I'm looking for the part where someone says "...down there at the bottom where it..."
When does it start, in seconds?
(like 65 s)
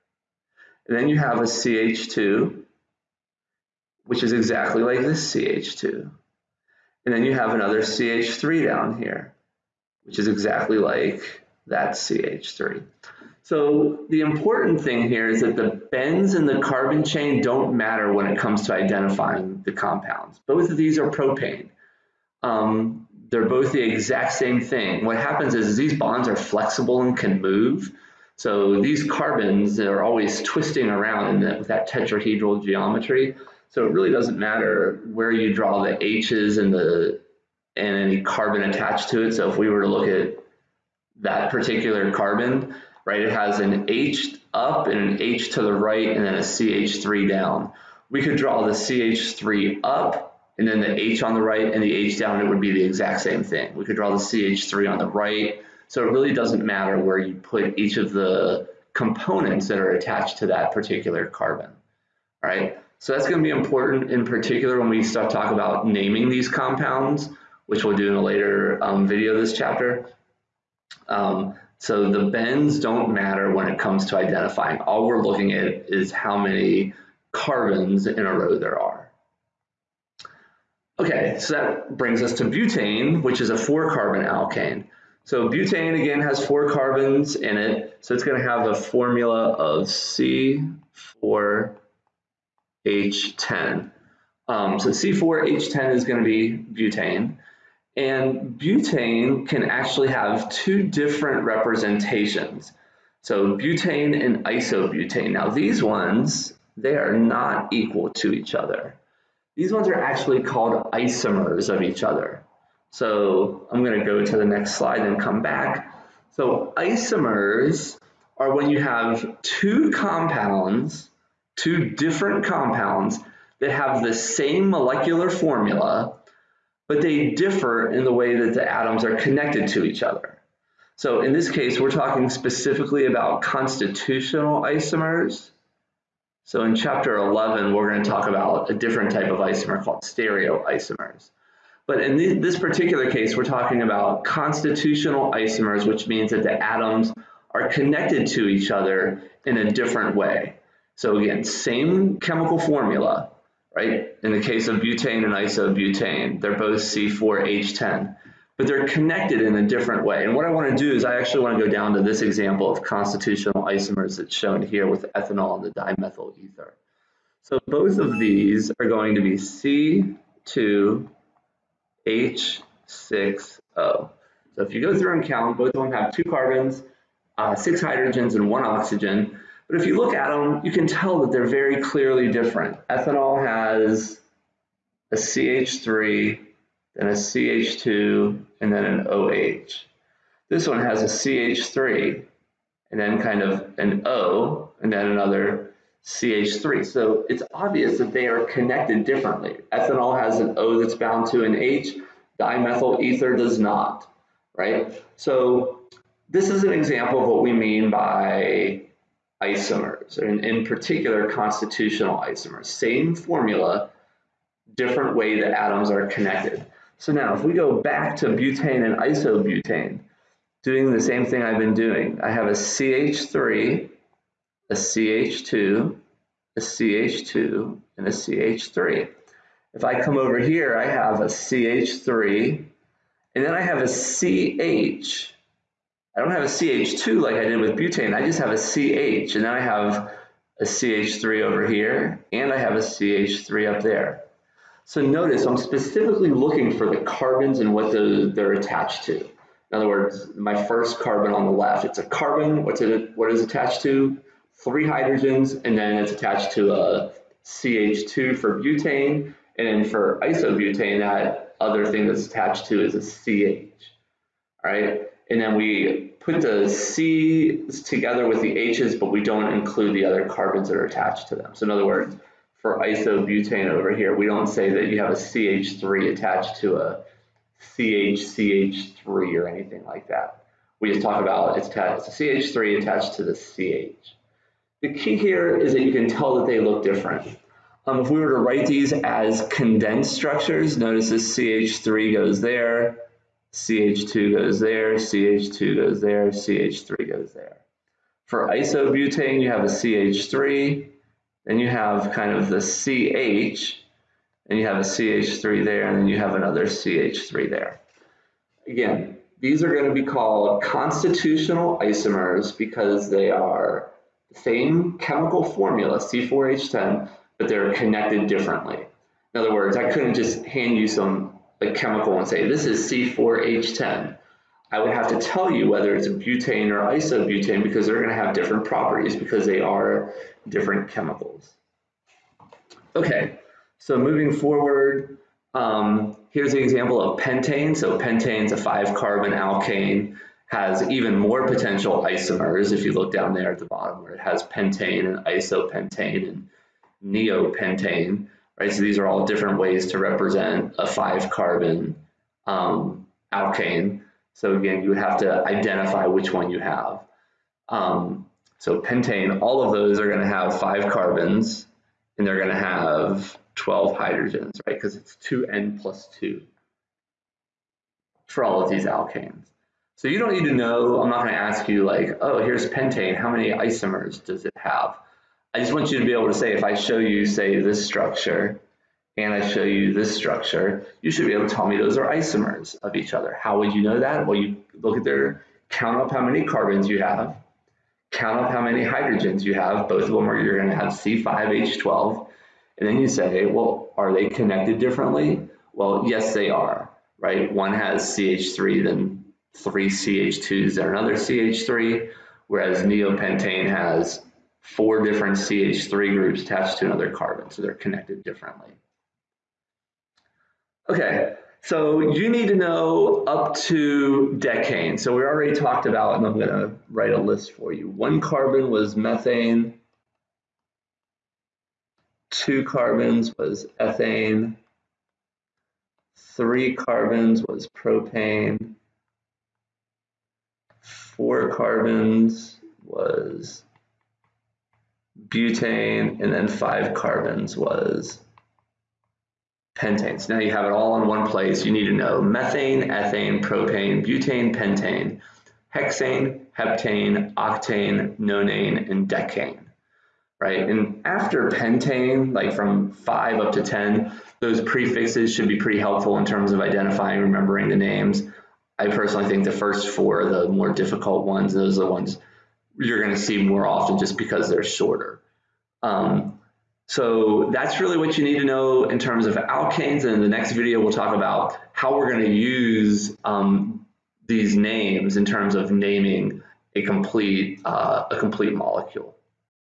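343 s.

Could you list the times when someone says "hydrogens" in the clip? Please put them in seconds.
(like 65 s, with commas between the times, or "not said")
177 s, 254 s, 363 s, 388 s.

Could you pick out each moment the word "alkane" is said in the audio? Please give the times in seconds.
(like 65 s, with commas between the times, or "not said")
84 s, 339 s, 353 s, 368 s, 469 s.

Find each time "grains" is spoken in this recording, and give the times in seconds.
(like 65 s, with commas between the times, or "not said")
not said.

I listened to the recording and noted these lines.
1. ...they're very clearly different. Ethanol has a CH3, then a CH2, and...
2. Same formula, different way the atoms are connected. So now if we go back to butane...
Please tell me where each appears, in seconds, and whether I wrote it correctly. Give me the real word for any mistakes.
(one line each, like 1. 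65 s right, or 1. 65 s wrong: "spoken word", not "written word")
1. 181 s right
2. 212 s right.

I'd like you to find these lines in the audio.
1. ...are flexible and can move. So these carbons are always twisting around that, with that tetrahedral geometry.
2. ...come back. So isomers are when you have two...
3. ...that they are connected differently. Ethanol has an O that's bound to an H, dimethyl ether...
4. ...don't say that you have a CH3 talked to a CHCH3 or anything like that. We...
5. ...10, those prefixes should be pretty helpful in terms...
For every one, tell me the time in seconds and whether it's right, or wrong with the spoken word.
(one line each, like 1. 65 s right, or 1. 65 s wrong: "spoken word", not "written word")
1. 26 s right
2. 115 s right
3. 197 s right
4. 274 s wrong: "attached", not "talked"
5. 453 s right.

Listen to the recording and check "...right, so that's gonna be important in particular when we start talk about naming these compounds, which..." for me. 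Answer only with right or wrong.
right.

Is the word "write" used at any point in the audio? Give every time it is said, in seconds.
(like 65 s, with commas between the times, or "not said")
288 s, 416 s.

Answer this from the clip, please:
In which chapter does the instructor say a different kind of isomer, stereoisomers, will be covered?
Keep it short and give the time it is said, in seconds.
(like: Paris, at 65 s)
Chapter 11, at 136 s.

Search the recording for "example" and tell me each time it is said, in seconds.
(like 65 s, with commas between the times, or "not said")
162 s, 206 s, 336 s.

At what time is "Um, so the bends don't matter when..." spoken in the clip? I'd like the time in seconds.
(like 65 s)
71 s.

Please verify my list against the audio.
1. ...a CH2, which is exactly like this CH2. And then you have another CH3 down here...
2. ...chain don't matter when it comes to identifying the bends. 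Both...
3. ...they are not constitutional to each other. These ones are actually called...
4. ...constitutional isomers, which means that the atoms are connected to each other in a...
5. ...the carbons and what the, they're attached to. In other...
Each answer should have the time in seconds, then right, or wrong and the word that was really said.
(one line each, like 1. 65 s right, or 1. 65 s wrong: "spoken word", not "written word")
1. 1 s right
2. 17 s wrong: "compounds", not "bends"
3. 106 s wrong: "equal", not "constitutional"
4. 144 s right
5. 246 s right.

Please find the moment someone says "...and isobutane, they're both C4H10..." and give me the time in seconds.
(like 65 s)
155 s.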